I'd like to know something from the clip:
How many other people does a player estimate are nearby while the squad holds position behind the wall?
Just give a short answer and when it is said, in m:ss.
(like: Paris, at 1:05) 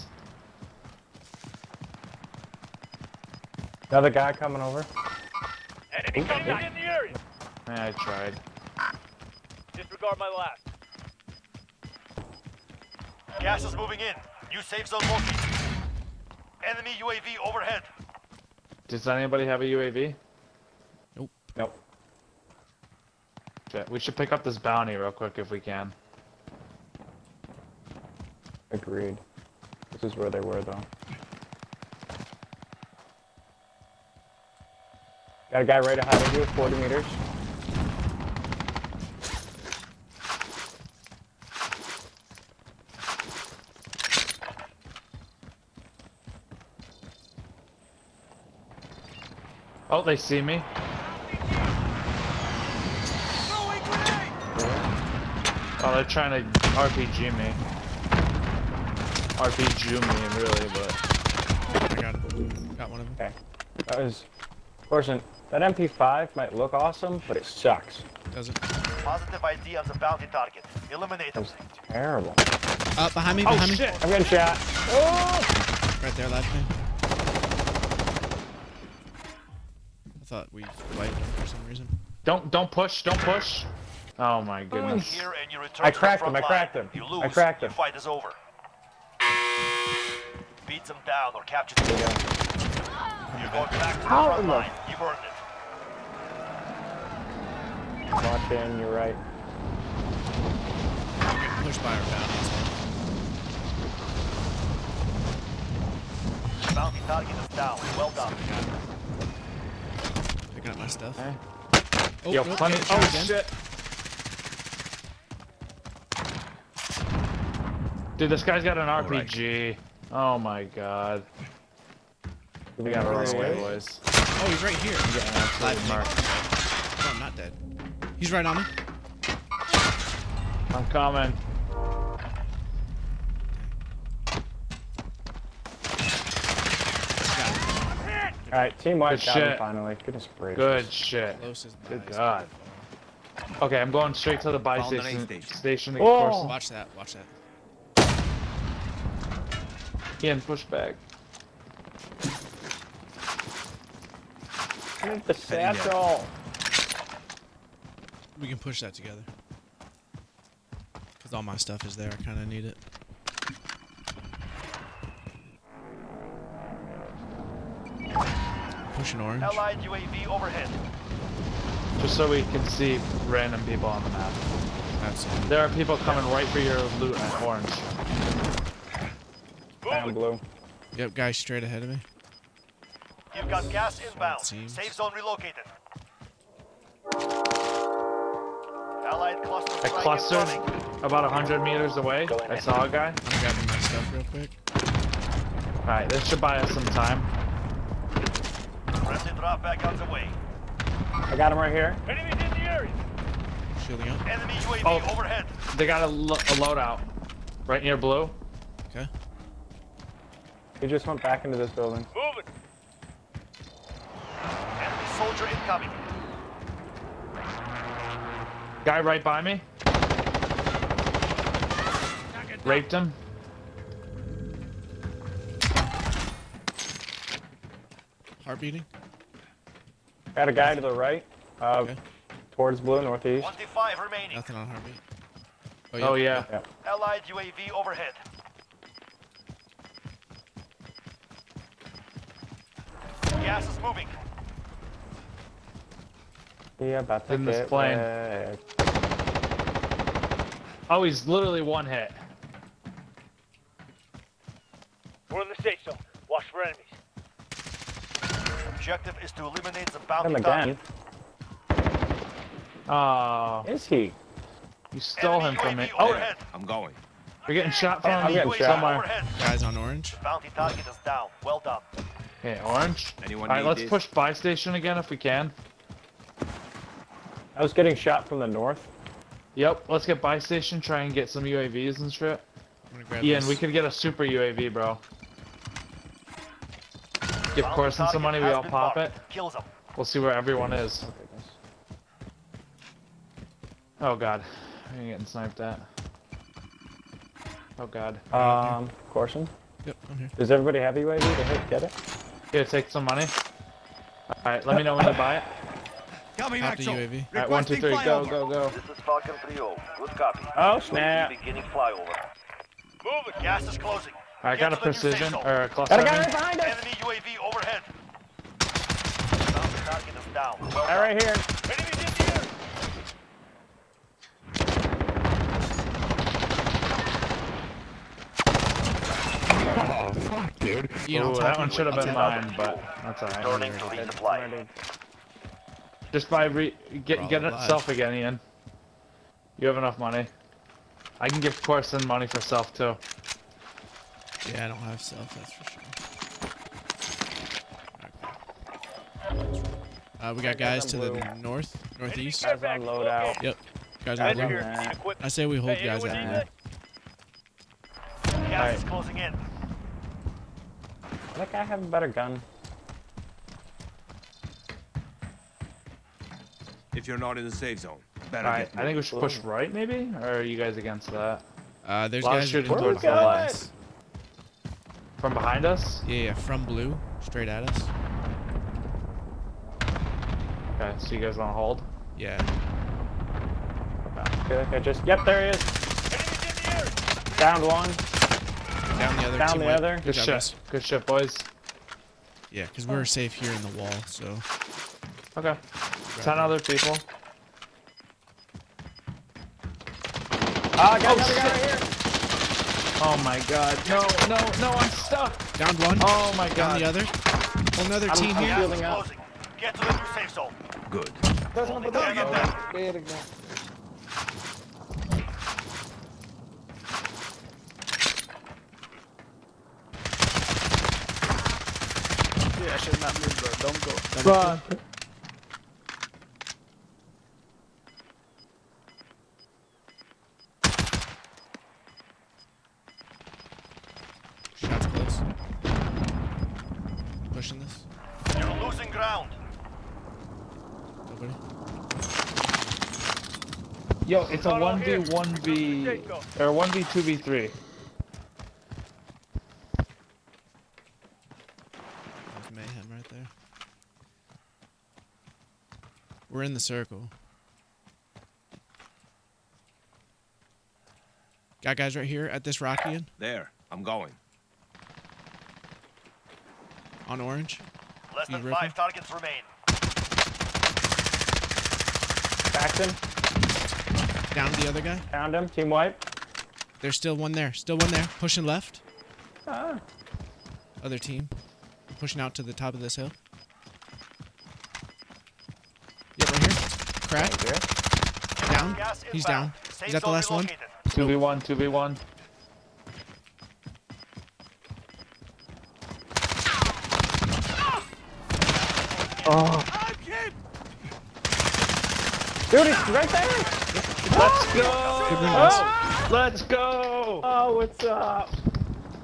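10, at 6:36.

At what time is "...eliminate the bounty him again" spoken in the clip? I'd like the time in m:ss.
4:19.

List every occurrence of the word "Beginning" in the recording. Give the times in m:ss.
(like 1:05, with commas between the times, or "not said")
5:11.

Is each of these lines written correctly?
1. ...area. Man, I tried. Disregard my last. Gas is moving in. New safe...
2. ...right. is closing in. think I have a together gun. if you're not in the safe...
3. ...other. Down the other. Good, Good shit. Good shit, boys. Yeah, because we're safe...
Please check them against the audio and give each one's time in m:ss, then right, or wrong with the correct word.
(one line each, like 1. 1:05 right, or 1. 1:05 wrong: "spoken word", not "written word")
1. 0:06 right
2. 5:58 wrong: "better", not "together"
3. 6:29 right.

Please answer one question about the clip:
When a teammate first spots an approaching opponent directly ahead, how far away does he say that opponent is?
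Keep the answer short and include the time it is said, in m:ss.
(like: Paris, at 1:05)
40 meters, at 0:36.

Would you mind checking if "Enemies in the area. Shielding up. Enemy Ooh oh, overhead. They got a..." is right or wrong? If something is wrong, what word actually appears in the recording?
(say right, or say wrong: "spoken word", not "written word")
wrong: "UAV", not "Ooh".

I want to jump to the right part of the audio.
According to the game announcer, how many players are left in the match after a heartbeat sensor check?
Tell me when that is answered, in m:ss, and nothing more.
3:53.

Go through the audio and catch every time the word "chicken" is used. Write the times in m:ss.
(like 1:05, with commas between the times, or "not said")
not said.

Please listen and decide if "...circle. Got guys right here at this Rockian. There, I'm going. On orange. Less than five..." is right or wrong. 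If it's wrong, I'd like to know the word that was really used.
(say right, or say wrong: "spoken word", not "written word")
right.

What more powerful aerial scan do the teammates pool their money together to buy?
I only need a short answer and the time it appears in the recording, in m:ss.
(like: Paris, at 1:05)
super UAV, at 4:43.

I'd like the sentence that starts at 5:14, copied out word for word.
I got a precision, or a cluster.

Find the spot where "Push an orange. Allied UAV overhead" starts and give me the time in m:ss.
2:48.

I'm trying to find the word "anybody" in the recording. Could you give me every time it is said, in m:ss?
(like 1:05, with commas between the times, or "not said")
0:19.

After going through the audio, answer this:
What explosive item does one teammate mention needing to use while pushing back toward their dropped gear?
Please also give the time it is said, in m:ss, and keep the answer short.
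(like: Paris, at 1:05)
satchel, at 2:35.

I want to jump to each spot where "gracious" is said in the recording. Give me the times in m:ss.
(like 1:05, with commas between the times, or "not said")
2:20.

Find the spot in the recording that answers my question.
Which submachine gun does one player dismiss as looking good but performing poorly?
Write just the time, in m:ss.
1:05.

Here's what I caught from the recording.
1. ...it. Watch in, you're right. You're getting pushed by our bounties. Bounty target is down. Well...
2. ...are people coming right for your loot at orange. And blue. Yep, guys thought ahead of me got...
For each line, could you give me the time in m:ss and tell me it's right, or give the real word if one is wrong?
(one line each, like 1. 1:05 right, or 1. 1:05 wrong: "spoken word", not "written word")
1. 1:38 right
2. 2:55 wrong: "straight", not "thought".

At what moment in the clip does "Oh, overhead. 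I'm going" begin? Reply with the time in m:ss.
4:25.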